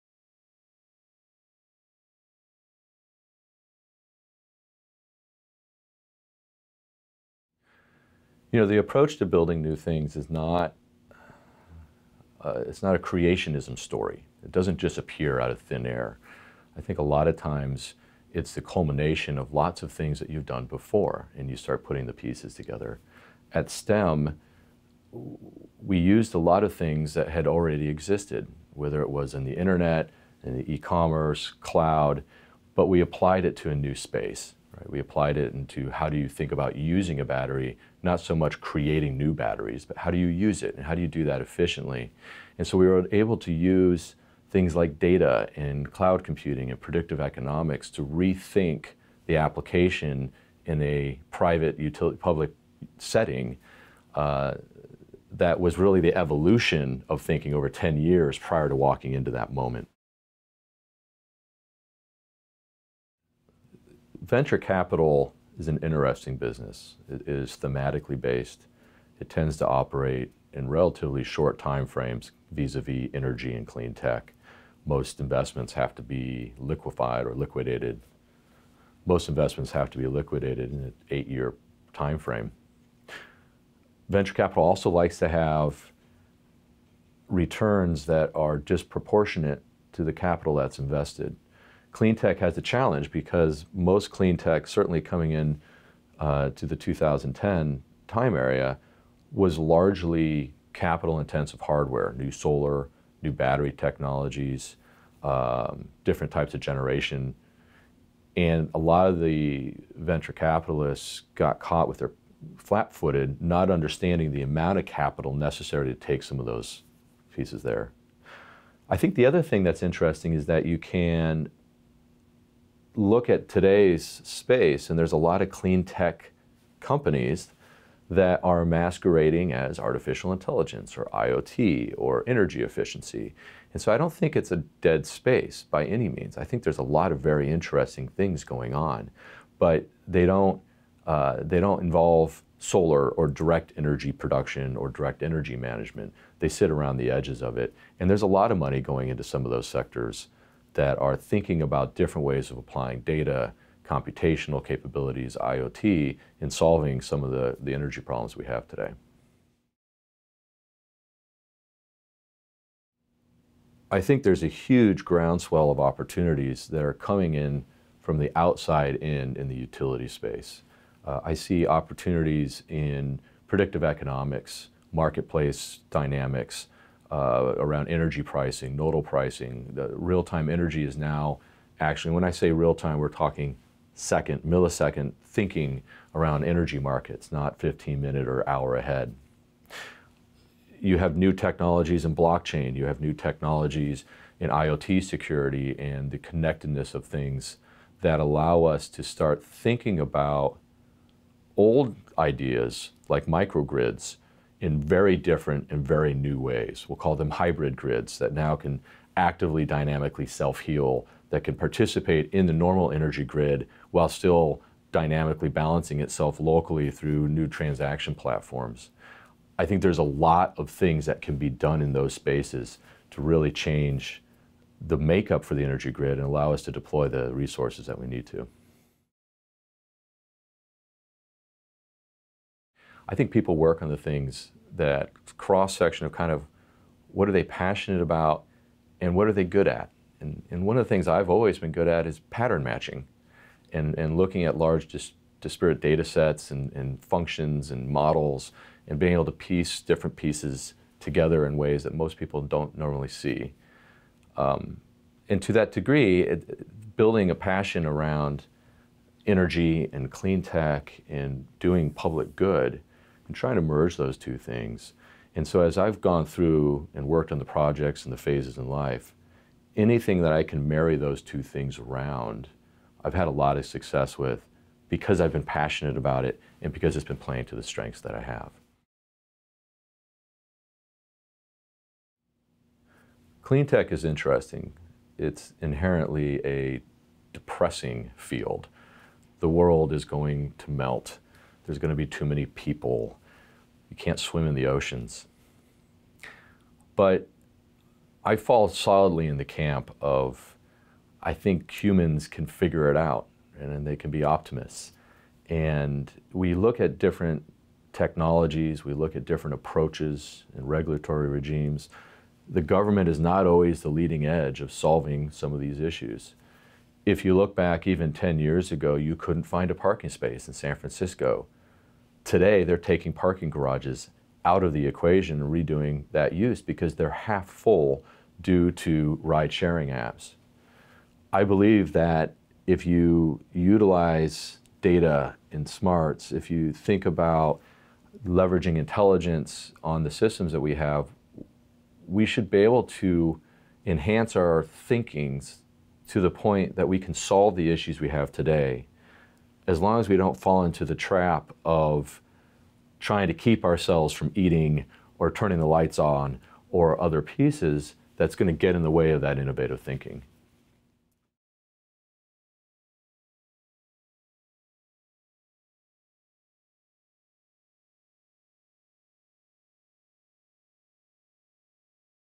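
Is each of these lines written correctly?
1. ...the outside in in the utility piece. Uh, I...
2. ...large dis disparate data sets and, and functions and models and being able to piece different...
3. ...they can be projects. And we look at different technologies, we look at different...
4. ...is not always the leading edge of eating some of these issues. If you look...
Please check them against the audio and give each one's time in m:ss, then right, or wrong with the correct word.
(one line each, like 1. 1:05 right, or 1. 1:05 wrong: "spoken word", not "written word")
1. 2:48 wrong: "space", not "piece"
2. 4:04 right
3. 5:03 wrong: "optimists", not "projects"
4. 5:13 wrong: "solving", not "eating".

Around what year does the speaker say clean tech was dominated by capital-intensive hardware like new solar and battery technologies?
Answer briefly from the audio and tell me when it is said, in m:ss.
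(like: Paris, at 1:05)
2010, at 1:36.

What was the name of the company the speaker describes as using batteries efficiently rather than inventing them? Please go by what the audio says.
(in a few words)
STEM.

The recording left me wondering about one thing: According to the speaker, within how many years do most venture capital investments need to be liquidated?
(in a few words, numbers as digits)
8 years.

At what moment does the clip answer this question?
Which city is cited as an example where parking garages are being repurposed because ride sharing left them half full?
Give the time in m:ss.
5:20.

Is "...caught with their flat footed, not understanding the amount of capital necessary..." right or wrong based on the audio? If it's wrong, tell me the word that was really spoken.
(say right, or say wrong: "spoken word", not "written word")
right.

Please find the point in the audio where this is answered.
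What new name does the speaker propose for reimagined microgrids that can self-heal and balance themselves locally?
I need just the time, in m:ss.
3:27.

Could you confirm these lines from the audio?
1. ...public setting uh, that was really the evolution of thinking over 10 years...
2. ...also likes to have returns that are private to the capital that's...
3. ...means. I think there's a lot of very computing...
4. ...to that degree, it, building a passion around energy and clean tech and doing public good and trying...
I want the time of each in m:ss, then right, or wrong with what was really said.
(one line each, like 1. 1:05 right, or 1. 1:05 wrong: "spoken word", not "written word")
1. 0:52 right
2. 1:24 wrong: "disproportionate", not "private"
3. 2:16 wrong: "interesting", not "computing"
4. 4:15 right.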